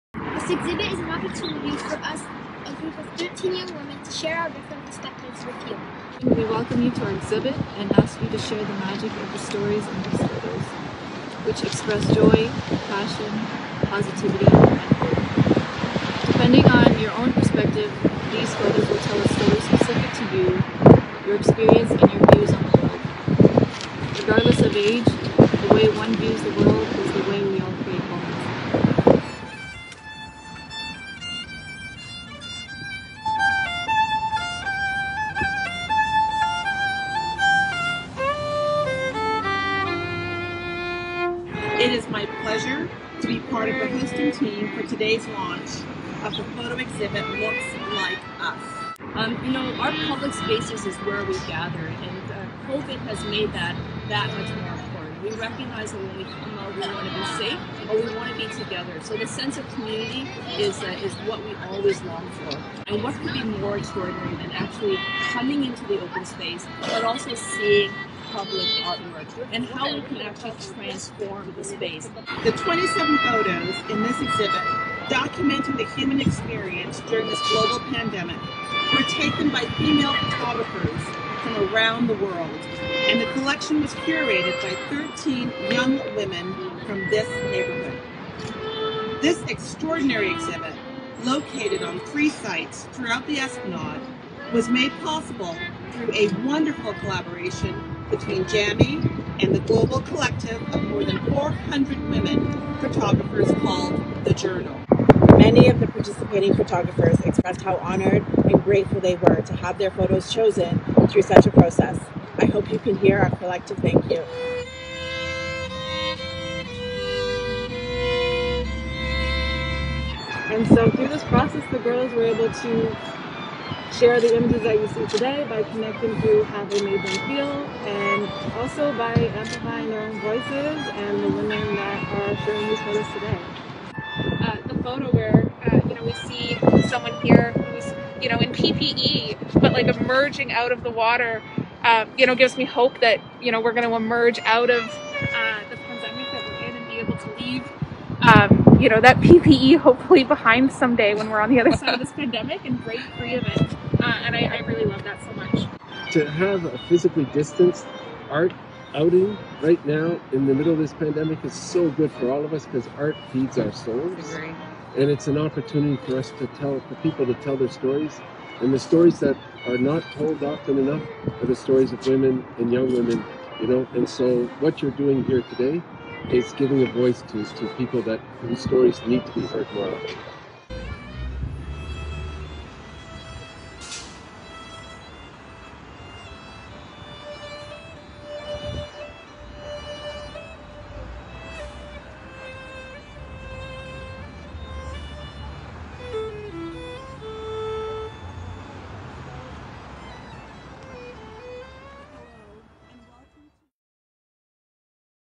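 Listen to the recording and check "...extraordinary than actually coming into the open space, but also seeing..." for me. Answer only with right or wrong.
right.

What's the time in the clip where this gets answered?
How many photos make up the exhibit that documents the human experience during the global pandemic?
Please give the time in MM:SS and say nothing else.
01:12.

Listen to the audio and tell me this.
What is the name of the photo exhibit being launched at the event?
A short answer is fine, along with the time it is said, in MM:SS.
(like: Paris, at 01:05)
Looks Like Us, at 00:47.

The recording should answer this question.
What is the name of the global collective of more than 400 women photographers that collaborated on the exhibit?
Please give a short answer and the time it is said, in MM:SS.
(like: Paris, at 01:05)
The Journal, at 01:44.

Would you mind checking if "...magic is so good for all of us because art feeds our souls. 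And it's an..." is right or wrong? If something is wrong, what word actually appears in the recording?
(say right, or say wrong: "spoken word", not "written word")
wrong: "pandemic", not "magic".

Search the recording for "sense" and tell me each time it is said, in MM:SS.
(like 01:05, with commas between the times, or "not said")
00:59.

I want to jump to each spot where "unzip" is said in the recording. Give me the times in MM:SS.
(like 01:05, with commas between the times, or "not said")
not said.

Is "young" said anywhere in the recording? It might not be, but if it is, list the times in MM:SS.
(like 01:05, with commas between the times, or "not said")
00:03, 01:25, 02:52.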